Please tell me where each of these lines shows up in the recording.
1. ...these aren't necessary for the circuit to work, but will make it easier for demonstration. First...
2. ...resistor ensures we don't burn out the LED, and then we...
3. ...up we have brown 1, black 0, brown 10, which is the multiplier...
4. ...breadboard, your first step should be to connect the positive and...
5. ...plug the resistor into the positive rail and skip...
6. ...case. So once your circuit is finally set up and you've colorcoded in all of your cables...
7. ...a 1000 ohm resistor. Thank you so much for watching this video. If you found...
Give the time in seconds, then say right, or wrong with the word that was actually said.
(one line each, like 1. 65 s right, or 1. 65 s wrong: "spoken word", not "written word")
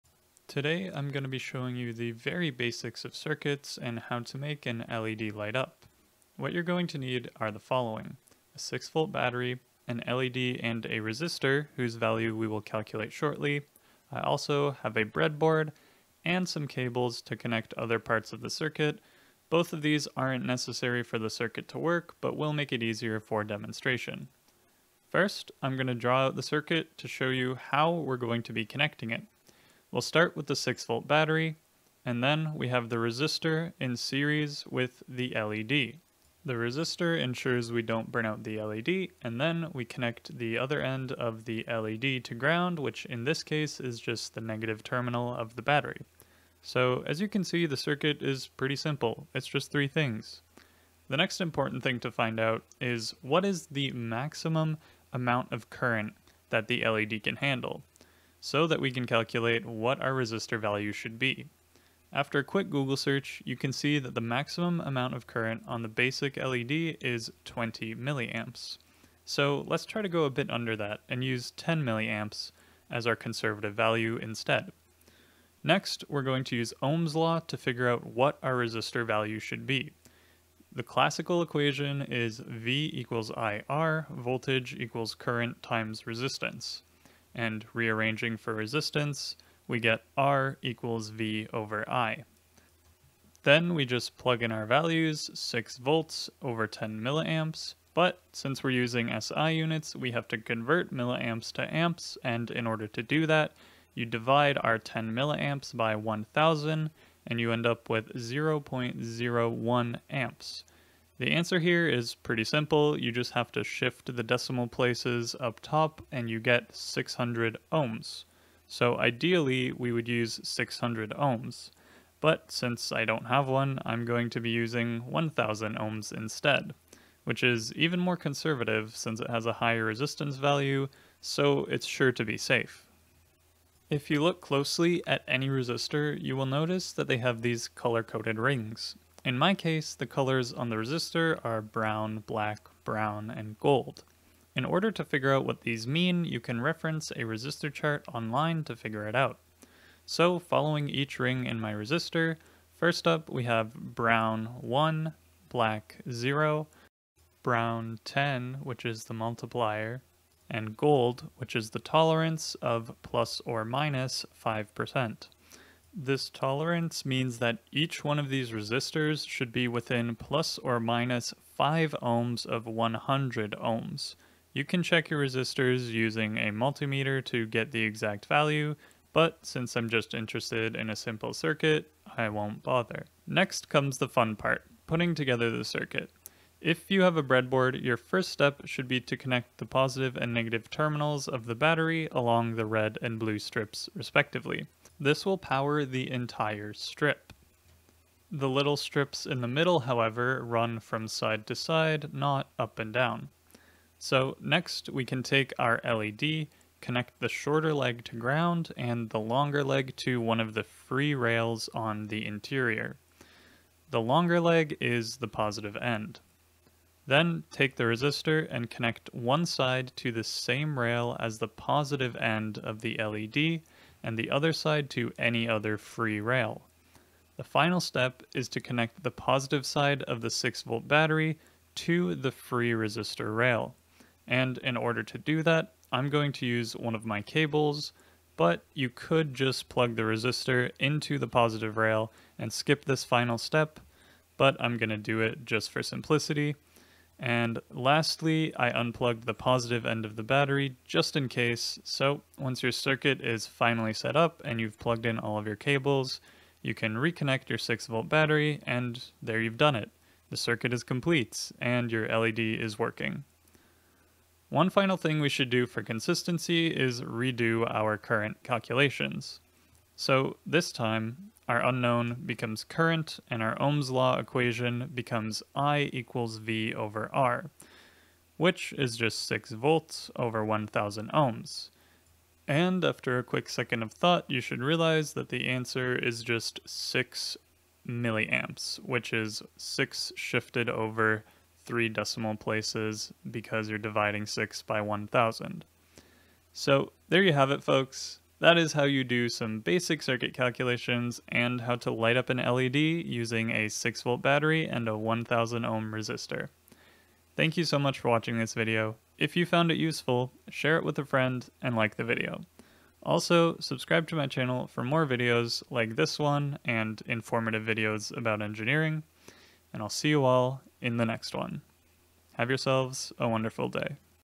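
1. 19 s right
2. 36 s right
3. 153 s right
4. 187 s right
5. 239 s right
6. 251 s wrong: "plugged", not "colorcoded"
7. 304 s right.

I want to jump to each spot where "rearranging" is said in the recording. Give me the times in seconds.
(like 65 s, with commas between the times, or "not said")
87 s.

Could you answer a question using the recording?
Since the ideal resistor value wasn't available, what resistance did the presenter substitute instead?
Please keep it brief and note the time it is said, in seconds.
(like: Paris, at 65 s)
1000 ohms, at 125 s.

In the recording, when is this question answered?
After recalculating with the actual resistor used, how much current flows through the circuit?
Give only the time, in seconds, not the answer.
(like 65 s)
286 s.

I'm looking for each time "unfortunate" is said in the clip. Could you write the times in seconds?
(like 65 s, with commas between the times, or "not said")
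not said.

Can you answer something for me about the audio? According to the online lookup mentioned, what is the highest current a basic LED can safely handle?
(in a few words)
20 milliamps.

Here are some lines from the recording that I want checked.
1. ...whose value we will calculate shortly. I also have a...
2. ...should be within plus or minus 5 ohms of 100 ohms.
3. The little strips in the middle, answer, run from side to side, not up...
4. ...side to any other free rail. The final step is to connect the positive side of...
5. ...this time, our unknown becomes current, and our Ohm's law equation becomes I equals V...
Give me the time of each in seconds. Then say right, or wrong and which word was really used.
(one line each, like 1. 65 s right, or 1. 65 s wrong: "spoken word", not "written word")
1. 11 s right
2. 169 s right
3. 198 s wrong: "however", not "answer"
4. 224 s right
5. 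270 s right.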